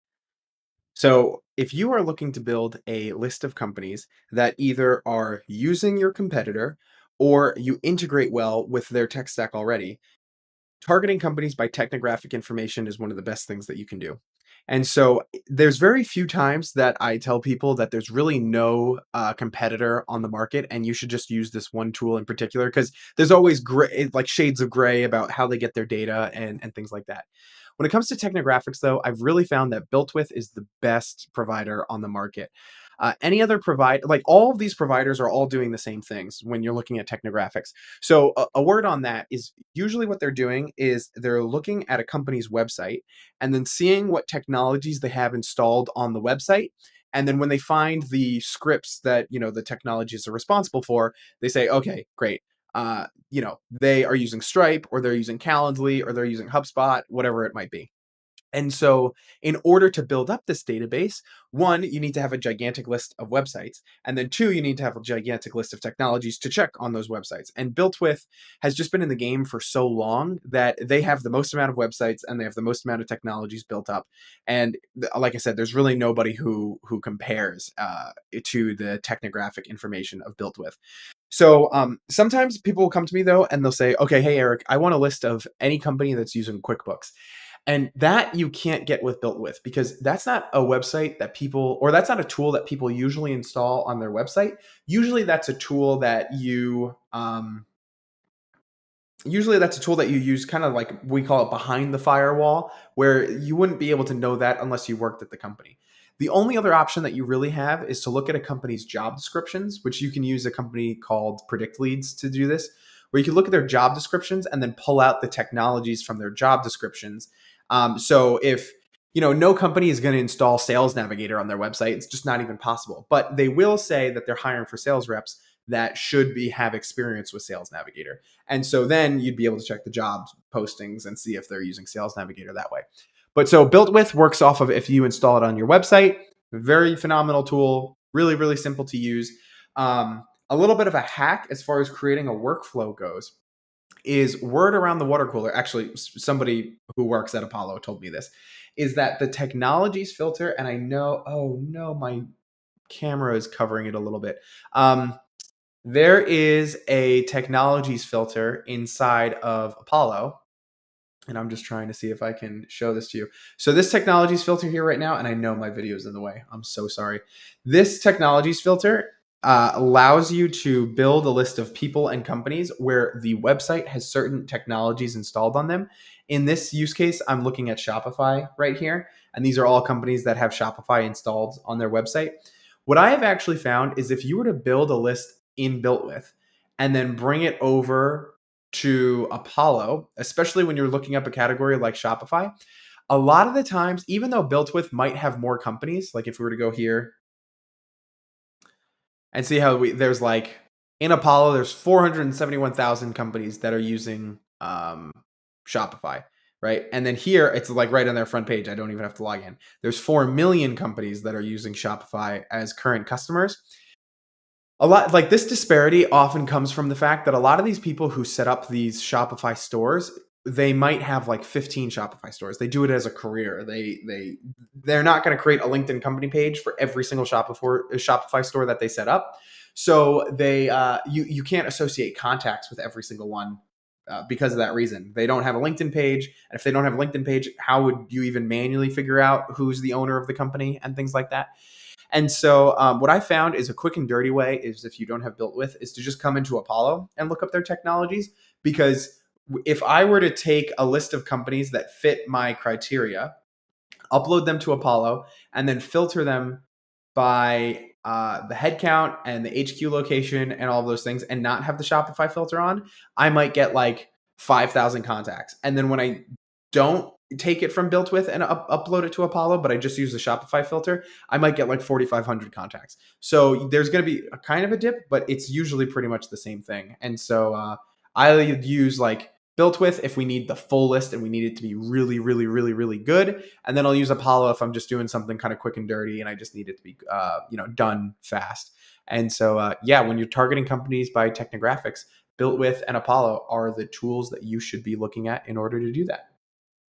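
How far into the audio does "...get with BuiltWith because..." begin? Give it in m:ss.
1:28.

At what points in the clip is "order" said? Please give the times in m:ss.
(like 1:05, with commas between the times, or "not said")
0:59, 4:55.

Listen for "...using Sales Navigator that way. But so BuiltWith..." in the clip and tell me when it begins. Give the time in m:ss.
2:11.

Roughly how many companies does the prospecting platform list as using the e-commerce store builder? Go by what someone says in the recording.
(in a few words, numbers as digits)
471,000.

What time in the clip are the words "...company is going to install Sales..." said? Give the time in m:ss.
1:59.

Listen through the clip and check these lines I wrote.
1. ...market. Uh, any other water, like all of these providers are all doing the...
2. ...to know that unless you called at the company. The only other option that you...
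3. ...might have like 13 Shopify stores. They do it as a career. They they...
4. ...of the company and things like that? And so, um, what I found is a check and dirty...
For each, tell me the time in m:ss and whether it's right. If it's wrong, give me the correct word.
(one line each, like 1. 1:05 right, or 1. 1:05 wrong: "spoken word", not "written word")
1. 0:32 wrong: "provider", not "water"
2. 1:44 wrong: "worked", not "called"
3. 3:40 wrong: "15", not "13"
4. 4:00 wrong: "quick", not "check".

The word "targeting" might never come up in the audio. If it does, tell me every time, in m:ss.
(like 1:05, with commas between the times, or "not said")
0:10, 4:50.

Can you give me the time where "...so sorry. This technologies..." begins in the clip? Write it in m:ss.
2:46.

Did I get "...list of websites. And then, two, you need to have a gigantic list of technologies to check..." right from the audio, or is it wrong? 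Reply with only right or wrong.
right.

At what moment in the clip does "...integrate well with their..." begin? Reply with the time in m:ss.
0:07.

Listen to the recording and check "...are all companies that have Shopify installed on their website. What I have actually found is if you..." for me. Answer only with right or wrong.
right.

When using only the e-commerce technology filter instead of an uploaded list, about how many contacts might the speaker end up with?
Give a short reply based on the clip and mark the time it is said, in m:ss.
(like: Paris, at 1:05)
4,500, at 4:31.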